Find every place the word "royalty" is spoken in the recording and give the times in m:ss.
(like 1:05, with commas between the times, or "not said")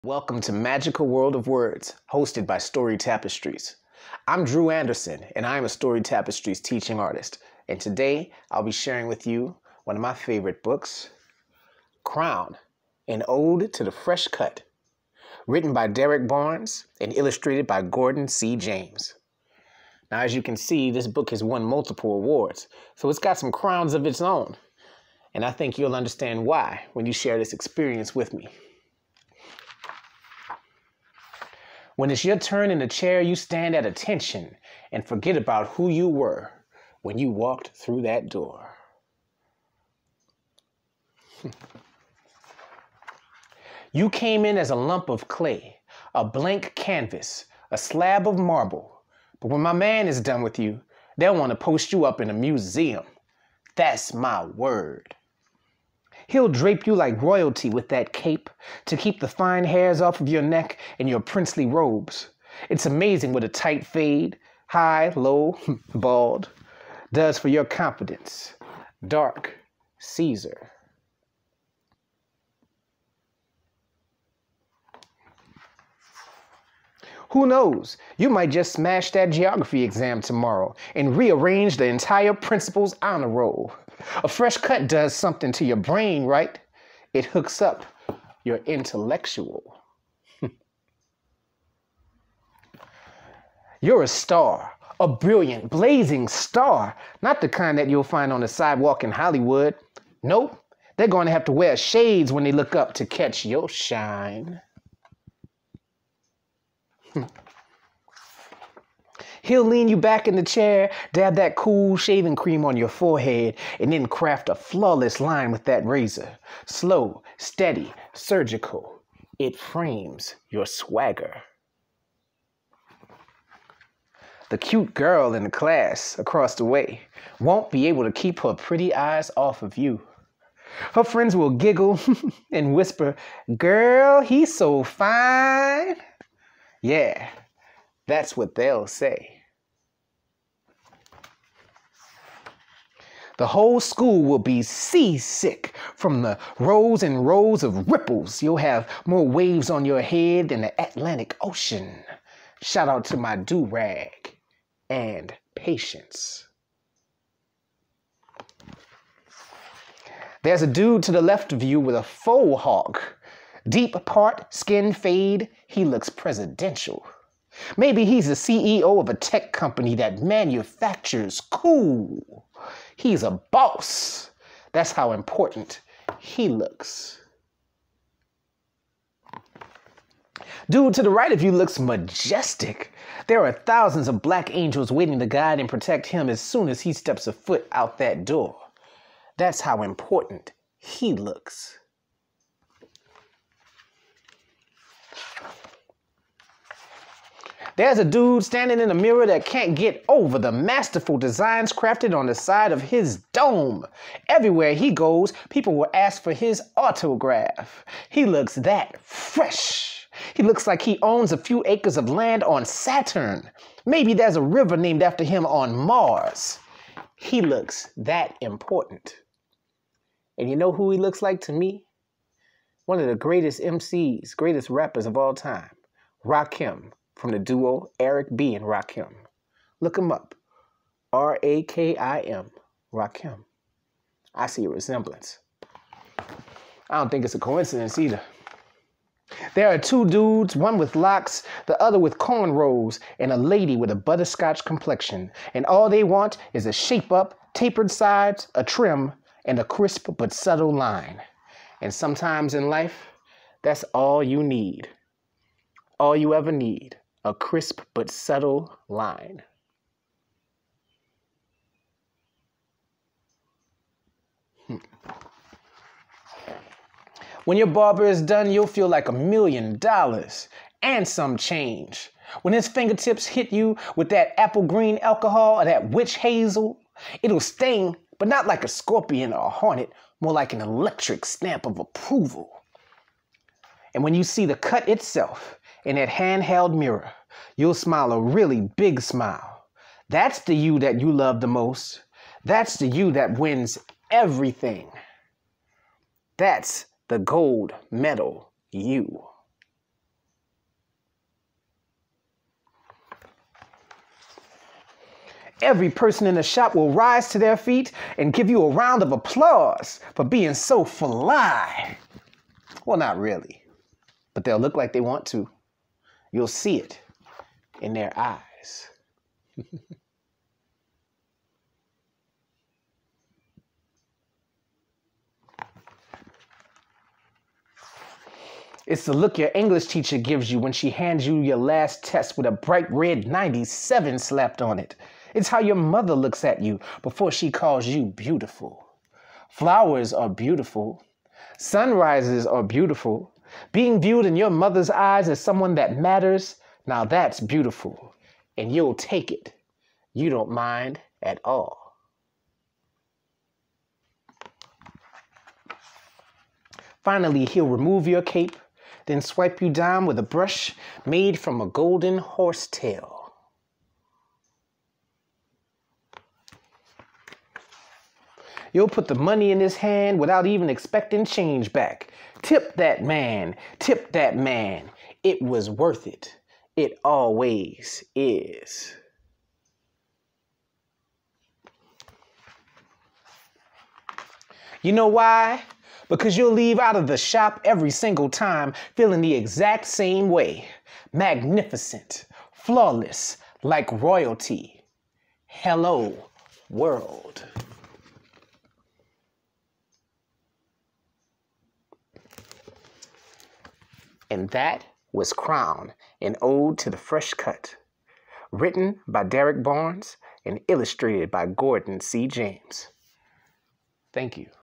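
0:57, 6:33.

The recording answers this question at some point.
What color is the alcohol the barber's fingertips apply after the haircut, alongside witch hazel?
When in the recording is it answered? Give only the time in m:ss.
4:34.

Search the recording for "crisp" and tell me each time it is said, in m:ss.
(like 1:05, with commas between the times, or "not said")
4:09, 4:17.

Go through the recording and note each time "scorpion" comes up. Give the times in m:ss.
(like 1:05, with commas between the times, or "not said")
4:38.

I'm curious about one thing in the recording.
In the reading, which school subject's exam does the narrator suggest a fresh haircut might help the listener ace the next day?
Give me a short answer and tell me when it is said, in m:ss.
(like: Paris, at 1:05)
geography, at 1:19.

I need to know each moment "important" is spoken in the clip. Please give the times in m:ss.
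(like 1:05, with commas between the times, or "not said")
2:55, 3:09, 3:38.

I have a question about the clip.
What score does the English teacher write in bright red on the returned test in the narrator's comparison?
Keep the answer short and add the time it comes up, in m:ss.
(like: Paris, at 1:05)
97, at 5:33.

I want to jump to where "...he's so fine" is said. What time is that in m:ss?
2:14.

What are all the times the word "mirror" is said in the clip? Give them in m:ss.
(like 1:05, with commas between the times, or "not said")
3:18, 4:46.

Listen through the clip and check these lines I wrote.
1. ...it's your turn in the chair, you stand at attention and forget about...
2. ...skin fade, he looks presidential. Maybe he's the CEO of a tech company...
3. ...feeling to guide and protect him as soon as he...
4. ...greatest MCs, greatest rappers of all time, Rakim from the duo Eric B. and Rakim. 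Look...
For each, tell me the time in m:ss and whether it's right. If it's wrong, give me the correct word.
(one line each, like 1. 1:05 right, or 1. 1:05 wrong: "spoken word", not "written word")
1. 0:32 right
2. 2:44 right
3. 3:04 wrong: "waiting", not "feeling"
4. 3:43 right.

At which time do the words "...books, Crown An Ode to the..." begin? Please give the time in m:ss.
0:10.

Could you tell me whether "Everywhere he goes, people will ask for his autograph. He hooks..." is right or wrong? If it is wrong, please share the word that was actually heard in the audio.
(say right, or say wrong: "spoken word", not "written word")
wrong: "looks", not "hooks".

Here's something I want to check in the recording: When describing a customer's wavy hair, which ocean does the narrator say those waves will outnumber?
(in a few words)
Atlantic Ocean.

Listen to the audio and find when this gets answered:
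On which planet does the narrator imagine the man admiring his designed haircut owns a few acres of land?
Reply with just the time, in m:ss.
3:32.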